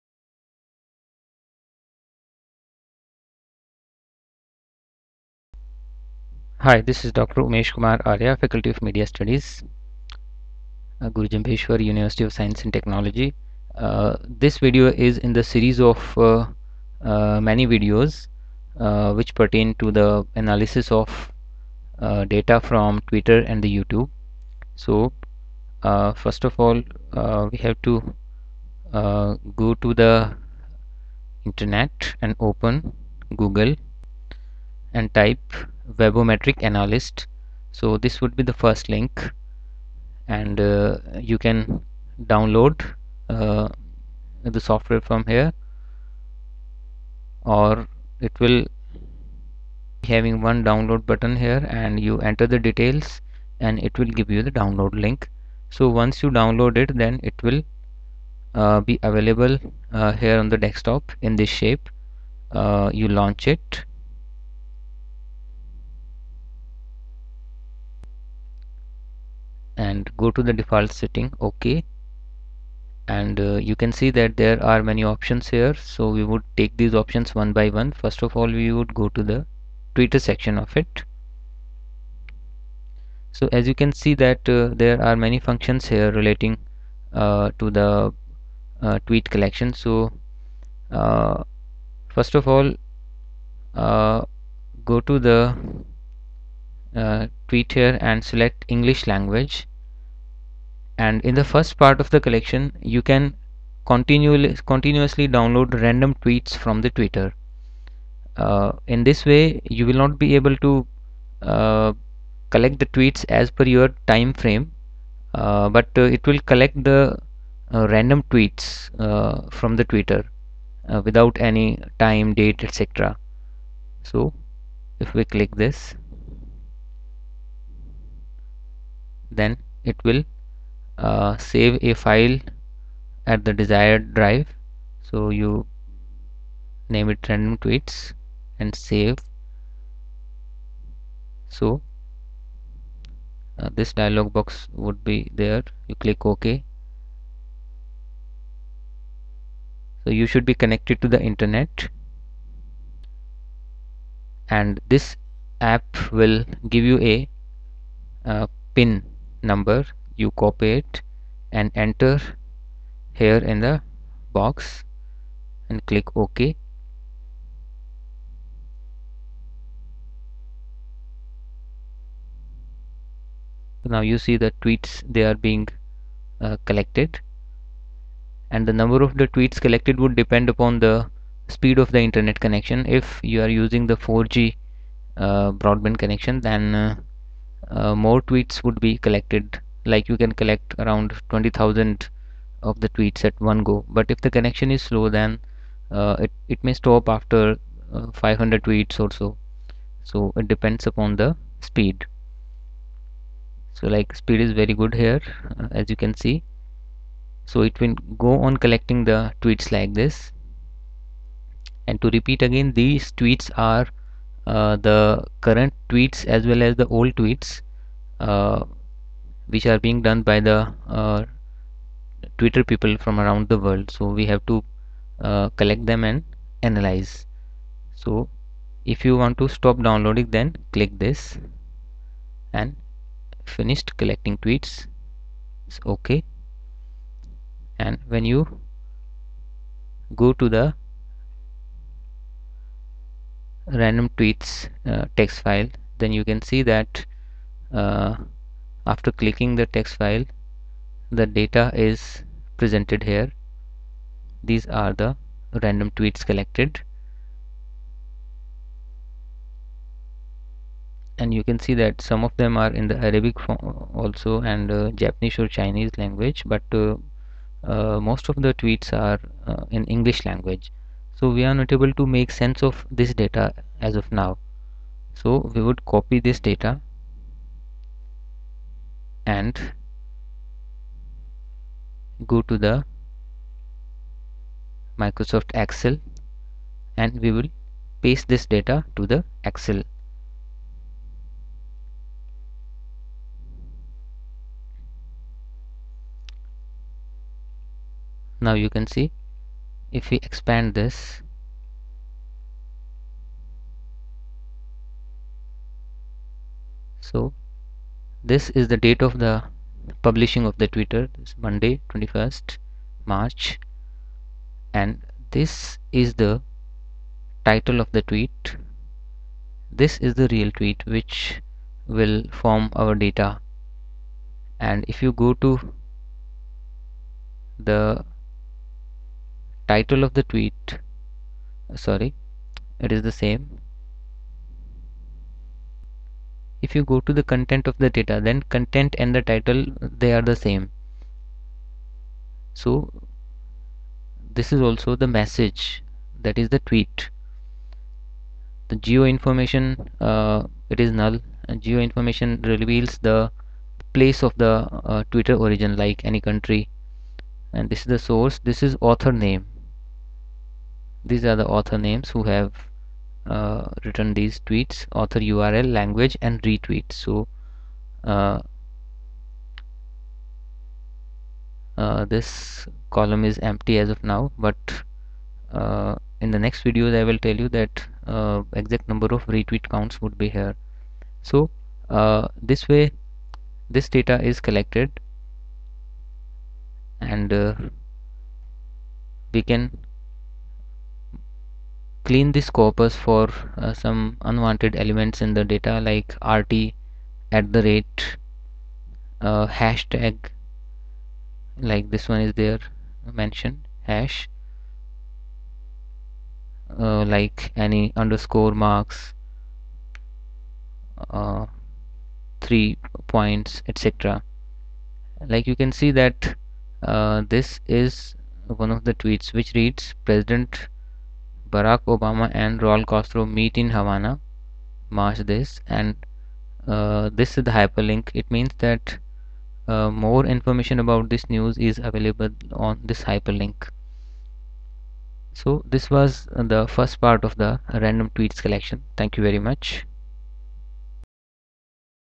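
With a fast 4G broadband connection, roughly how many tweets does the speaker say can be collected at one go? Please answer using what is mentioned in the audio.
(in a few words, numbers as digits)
20,000.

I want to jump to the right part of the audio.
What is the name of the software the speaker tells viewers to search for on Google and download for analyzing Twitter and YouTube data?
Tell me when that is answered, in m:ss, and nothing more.
0:35.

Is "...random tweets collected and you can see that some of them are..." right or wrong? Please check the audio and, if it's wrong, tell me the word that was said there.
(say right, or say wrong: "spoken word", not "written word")
right.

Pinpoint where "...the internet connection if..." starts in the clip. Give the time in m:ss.
3:01.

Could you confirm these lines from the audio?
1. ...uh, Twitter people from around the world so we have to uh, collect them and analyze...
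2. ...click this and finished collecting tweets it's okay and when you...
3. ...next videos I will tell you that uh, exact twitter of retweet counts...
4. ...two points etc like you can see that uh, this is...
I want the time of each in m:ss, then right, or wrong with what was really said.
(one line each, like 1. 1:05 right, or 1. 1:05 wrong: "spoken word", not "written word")
1. 3:40 right
2. 3:50 right
3. 6:16 wrong: "number", not "twitter"
4. 6:52 wrong: "three", not "two".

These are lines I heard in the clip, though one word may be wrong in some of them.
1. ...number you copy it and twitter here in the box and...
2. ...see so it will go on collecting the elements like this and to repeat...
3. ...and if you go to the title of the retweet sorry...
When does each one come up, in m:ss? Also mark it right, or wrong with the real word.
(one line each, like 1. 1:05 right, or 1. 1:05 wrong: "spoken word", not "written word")
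1. 2:39 wrong: "enter", not "twitter"
2. 3:26 wrong: "tweets", not "elements"
3. 5:24 wrong: "tweet", not "retweet".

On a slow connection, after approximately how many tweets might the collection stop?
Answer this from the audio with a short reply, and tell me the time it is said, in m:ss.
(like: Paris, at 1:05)
500, at 3:18.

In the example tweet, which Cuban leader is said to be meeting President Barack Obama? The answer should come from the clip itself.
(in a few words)
Raul Castro.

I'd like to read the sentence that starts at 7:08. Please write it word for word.
It means that uh, more information about this news is available on this hyperlink.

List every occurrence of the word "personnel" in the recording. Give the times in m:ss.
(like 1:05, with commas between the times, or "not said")
not said.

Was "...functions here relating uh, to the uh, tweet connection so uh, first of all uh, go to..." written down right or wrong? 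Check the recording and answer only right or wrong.
wrong.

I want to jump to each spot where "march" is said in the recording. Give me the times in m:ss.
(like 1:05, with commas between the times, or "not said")
5:13, 7:04.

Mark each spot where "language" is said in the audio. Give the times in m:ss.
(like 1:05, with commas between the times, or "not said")
1:39, 4:25, 4:30, 6:05.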